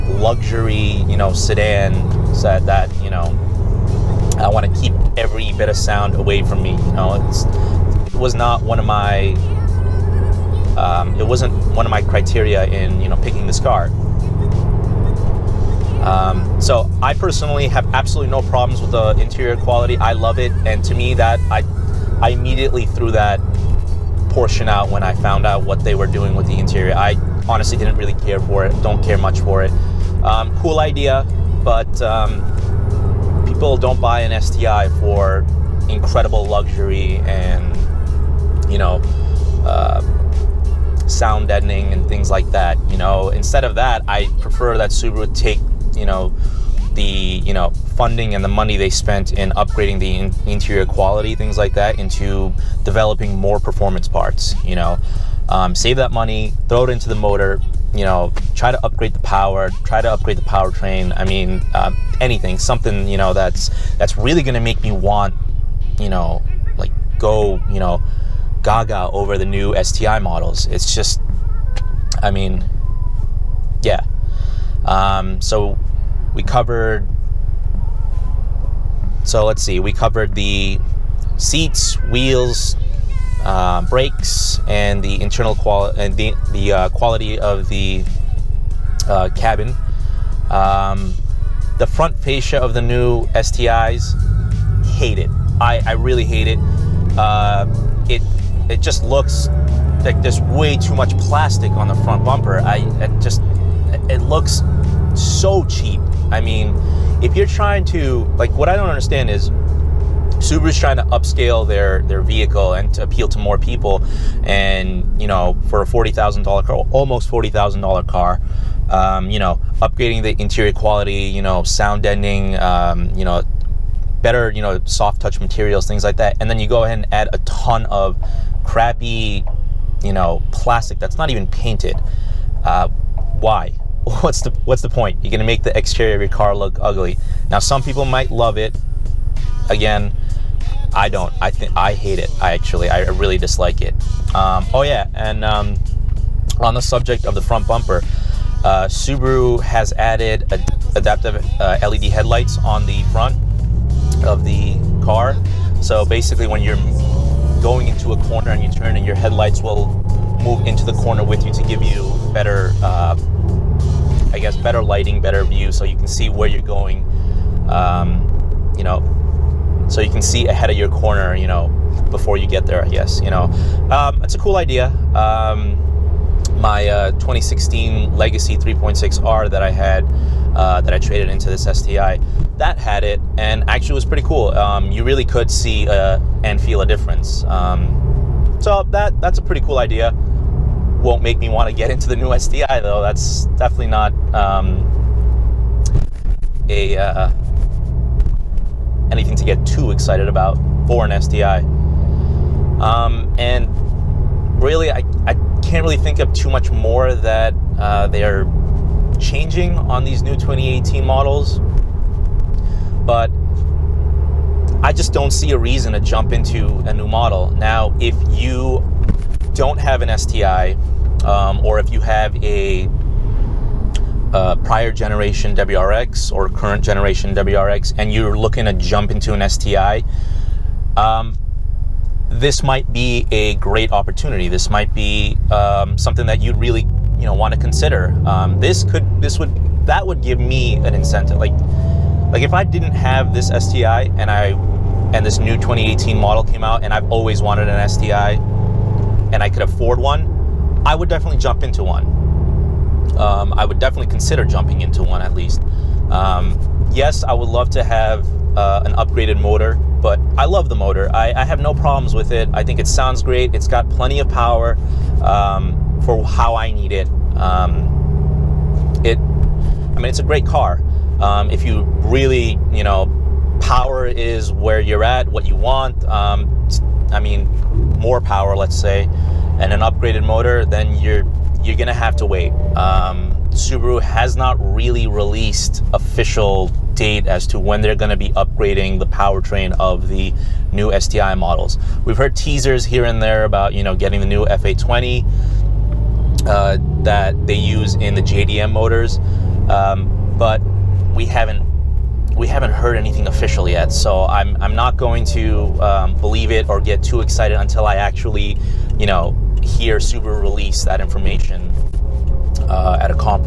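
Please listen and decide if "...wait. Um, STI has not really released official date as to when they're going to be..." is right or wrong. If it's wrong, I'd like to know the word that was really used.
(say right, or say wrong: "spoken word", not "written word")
wrong: "Subaru", not "STI".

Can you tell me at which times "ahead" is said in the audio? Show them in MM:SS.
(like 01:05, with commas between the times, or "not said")
02:06, 02:50.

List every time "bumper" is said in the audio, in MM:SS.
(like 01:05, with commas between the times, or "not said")
01:42, 02:27.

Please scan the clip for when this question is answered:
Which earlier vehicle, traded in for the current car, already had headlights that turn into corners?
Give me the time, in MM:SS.
02:57.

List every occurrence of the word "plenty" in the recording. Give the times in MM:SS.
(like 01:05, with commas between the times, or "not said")
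04:23.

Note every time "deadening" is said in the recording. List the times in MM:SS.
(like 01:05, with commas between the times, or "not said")
00:41, 02:02.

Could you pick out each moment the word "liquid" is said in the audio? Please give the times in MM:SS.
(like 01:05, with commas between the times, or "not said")
not said.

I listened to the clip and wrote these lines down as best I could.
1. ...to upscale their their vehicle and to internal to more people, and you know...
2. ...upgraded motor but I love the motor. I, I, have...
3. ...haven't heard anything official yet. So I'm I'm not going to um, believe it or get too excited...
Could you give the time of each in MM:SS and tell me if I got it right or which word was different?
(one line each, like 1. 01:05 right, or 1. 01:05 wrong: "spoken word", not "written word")
1. 01:50 wrong: "appeal", not "internal"
2. 04:18 right
3. 05:02 right.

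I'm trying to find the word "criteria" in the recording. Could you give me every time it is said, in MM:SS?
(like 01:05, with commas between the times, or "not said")
00:12.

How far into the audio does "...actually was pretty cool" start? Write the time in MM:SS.
03:03.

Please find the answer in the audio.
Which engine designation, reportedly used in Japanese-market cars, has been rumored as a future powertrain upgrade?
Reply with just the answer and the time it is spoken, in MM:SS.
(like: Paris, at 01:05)
FA20, at 04:54.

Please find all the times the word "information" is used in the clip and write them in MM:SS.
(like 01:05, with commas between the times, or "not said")
05:10.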